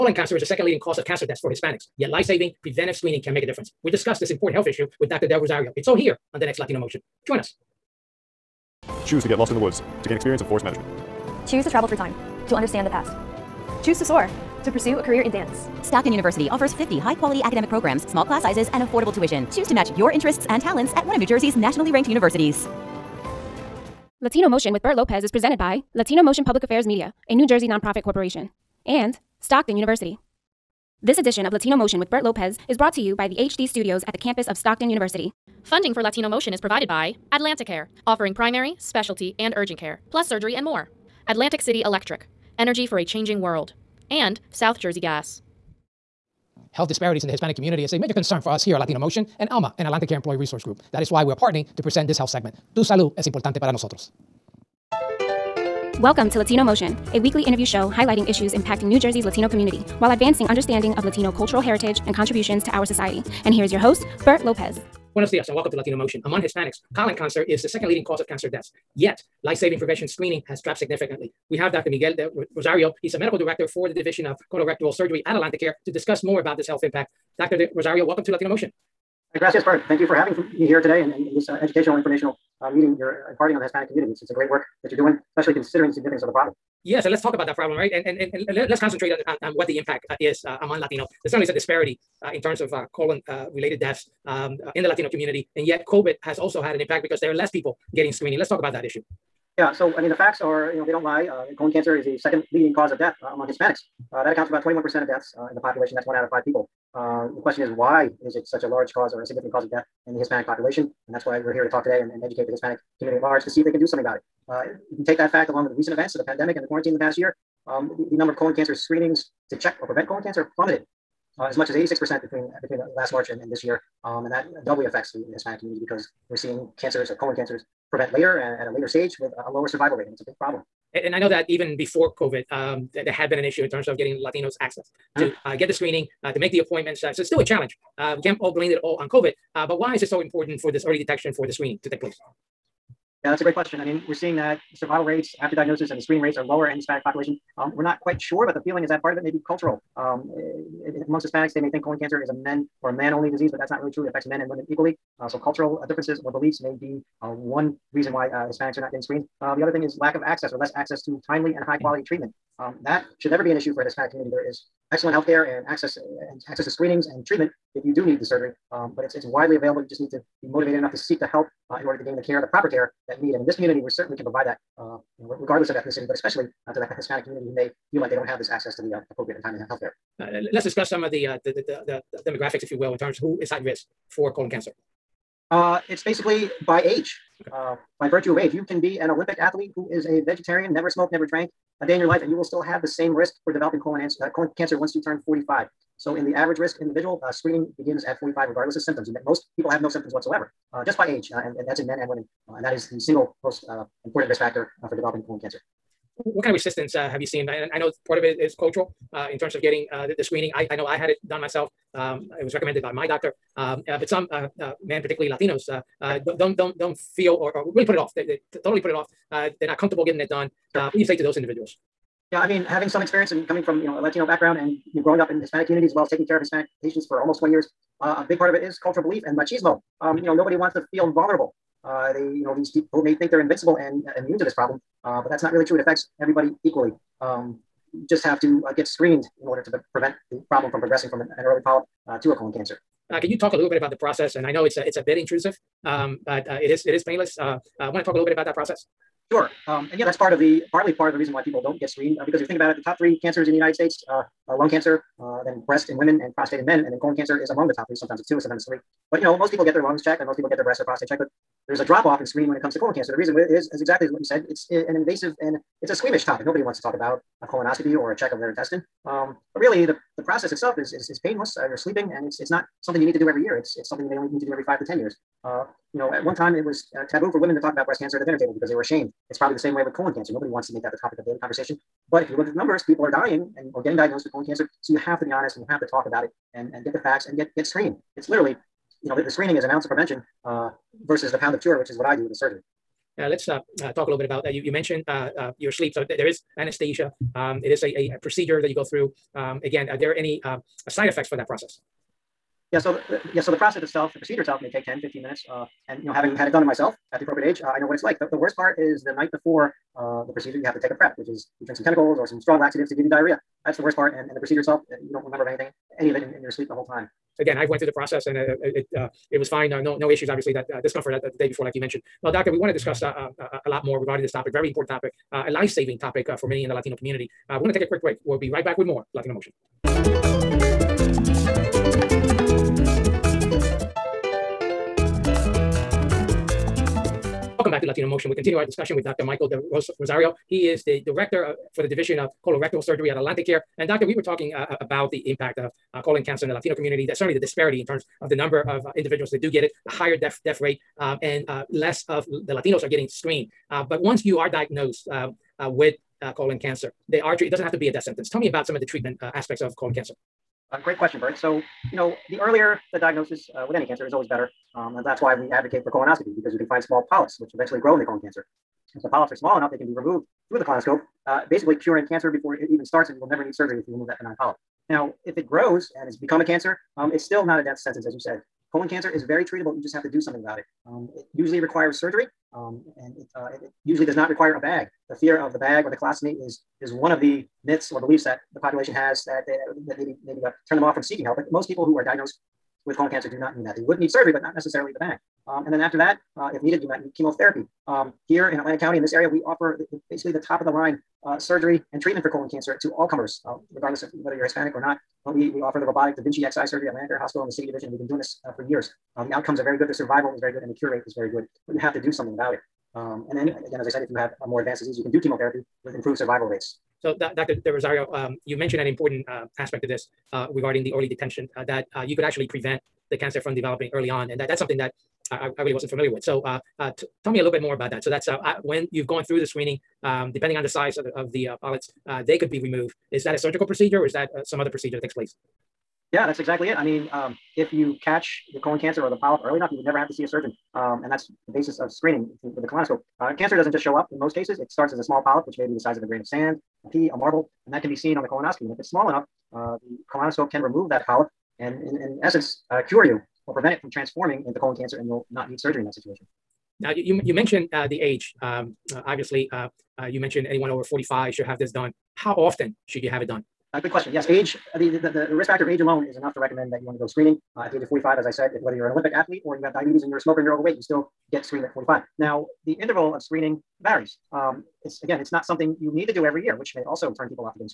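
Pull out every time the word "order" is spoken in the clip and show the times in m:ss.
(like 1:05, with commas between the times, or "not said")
2:51, 3:59.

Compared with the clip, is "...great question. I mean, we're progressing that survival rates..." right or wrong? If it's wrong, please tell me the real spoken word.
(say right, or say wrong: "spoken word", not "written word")
wrong: "seeing", not "progressing".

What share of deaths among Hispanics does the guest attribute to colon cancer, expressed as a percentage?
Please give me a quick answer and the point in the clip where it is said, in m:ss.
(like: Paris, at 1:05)
21%, at 1:44.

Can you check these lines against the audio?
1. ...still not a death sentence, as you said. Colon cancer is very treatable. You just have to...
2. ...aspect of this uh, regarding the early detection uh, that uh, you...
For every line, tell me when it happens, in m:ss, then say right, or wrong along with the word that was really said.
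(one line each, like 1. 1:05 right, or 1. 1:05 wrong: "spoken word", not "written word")
1. 6:17 right
2. 6:59 right.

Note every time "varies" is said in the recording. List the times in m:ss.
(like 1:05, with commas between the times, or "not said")
7:53.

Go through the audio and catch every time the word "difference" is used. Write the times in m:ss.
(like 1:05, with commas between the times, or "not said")
0:03, 2:35.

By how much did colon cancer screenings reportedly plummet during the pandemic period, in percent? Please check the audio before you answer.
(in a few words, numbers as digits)
86%.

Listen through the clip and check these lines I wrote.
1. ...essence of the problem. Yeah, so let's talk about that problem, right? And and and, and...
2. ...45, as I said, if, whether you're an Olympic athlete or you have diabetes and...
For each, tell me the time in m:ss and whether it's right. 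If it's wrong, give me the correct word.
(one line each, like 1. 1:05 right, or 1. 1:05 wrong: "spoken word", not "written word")
1. 1:25 wrong: "significance", not "essence"
2. 7:47 right.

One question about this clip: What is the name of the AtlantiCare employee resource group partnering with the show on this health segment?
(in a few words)
ELMA.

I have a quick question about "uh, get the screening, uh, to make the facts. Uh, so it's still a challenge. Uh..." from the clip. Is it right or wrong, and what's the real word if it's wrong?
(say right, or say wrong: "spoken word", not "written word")
wrong: "appointments", not "facts".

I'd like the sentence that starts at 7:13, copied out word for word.
Is that a surgical procedure or is that uh, some other procedure that takes place?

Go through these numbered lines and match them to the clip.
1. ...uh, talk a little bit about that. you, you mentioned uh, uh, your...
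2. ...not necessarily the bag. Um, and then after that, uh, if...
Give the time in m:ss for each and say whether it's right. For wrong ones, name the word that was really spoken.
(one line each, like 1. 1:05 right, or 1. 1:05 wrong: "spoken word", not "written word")
1. 4:53 right
2. 6:34 right.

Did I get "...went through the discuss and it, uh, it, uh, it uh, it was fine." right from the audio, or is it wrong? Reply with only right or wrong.
wrong.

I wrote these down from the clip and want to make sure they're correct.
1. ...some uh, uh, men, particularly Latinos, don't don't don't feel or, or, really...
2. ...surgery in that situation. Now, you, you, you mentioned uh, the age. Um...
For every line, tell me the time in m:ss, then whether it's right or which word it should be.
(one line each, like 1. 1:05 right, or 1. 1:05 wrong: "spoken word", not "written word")
1. 3:34 right
2. 7:35 right.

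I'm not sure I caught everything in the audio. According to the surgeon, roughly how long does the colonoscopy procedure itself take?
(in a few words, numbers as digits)
10 to 15 minutes.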